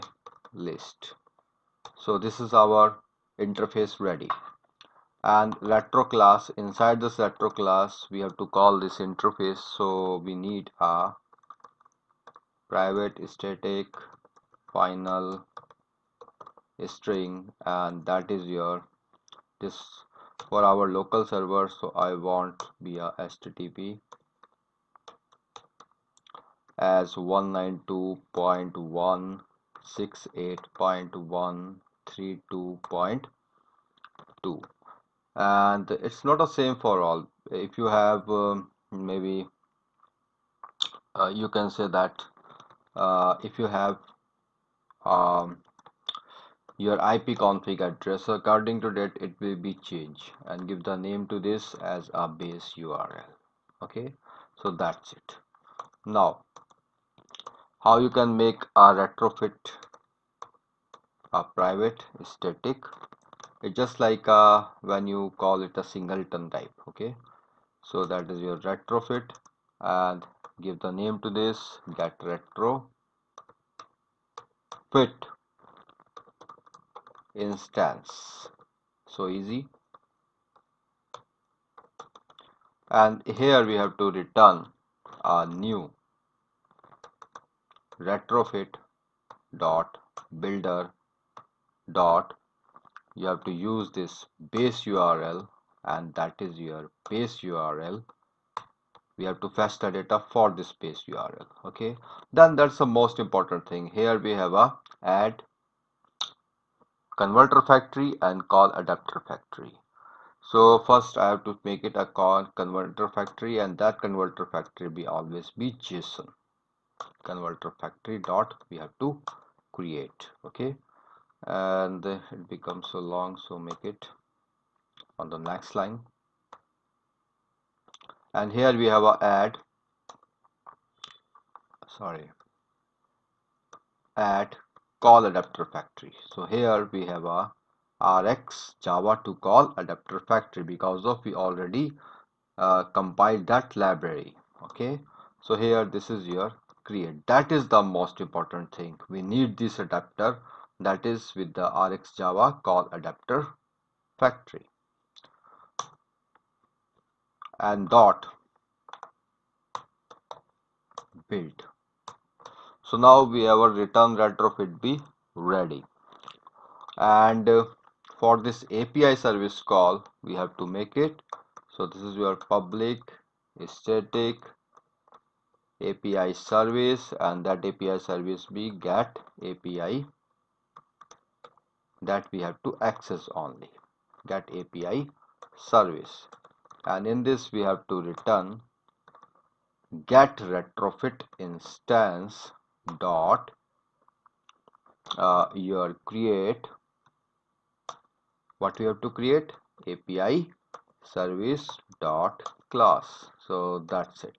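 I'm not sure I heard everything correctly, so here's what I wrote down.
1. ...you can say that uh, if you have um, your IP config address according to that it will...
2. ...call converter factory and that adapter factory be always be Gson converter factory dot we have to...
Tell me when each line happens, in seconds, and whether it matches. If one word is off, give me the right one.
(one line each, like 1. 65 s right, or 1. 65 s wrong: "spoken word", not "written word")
1. 41 s right
2. 112 s wrong: "converter", not "adapter".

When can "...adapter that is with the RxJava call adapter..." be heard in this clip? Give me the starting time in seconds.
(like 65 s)
149 s.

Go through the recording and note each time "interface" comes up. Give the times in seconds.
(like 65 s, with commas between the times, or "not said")
3 s, 8 s.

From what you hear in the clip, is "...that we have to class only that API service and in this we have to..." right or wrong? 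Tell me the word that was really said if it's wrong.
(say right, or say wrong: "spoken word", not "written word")
wrong: "access", not "class".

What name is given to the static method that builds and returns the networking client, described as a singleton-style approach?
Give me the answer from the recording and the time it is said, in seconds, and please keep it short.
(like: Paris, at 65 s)
get retrofit instance, at 71 s.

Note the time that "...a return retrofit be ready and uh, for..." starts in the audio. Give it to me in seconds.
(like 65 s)
163 s.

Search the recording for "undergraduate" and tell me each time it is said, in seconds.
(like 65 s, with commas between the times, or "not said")
not said.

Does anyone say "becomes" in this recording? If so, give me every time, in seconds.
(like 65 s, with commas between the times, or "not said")
122 s.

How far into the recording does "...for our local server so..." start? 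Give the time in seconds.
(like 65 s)
20 s.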